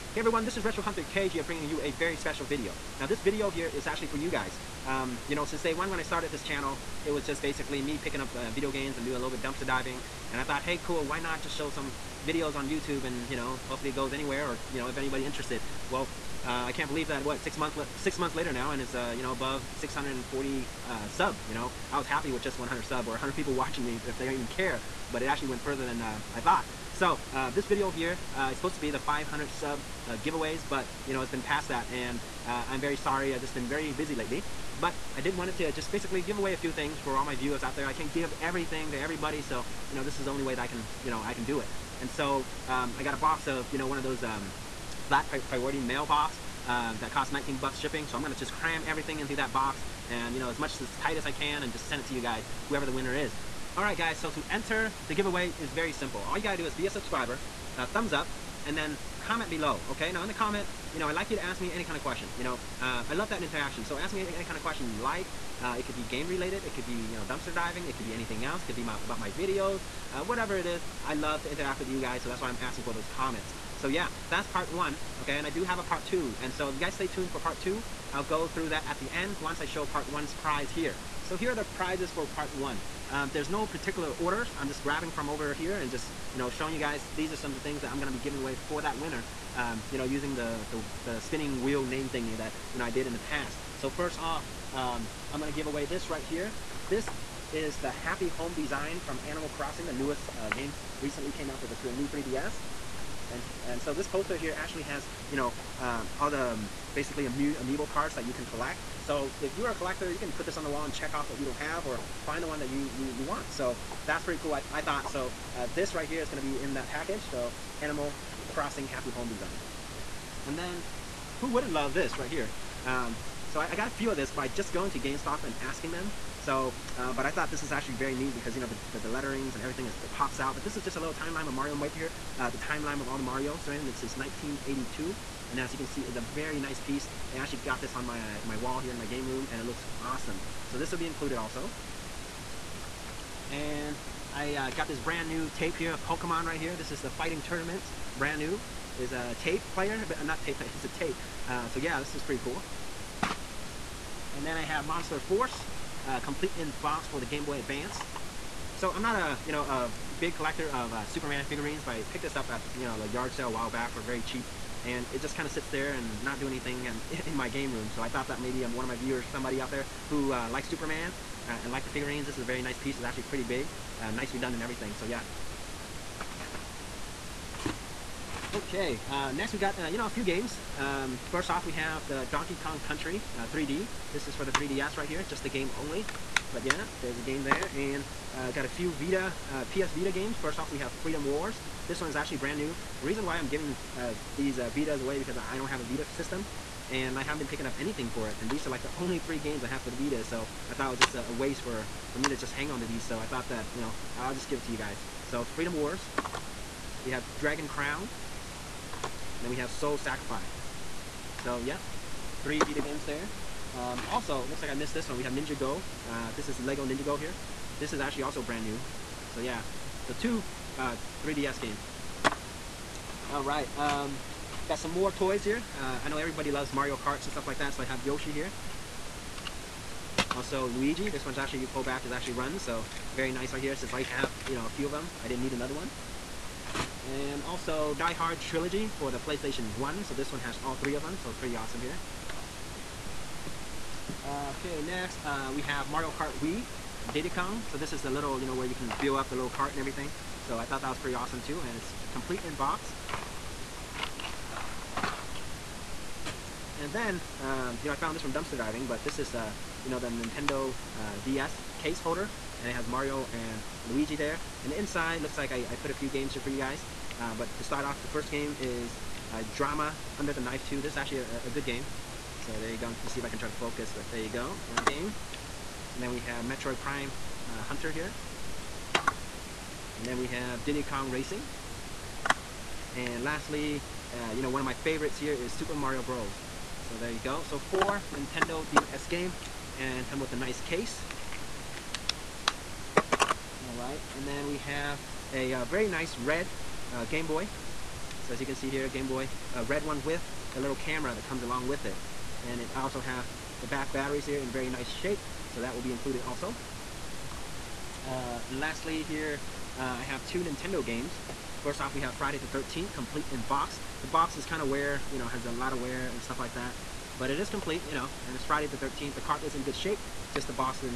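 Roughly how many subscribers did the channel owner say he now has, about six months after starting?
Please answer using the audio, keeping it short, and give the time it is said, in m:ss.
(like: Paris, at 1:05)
640, at 0:19.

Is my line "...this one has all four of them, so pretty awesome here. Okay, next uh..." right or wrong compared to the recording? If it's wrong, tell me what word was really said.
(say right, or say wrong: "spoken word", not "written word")
wrong: "three", not "four".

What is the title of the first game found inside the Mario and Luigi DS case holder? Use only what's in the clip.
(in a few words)
Trauma Under the Knife 2.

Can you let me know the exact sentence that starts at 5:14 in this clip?
The box is kind of wear, you know, has a lot of wear and stuff like that.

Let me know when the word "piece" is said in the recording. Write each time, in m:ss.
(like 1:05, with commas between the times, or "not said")
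2:16, 2:52.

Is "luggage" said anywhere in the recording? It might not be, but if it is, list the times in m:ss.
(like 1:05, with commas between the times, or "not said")
not said.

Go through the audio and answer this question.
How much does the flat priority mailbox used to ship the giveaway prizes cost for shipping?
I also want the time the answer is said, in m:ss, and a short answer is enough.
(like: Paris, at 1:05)
19 bucks, at 0:47.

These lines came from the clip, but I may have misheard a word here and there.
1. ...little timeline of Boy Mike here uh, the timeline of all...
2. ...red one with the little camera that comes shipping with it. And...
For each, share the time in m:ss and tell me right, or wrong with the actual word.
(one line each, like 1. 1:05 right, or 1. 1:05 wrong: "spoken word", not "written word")
1. 2:10 wrong: "Mario", not "Boy"
2. 4:59 wrong: "along", not "shipping".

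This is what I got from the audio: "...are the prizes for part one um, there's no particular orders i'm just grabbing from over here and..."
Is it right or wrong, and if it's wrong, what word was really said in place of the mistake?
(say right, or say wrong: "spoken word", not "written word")
right.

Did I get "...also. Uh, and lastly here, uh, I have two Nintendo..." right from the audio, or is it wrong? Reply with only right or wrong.
right.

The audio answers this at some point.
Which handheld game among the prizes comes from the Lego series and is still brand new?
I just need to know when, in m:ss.
3:36.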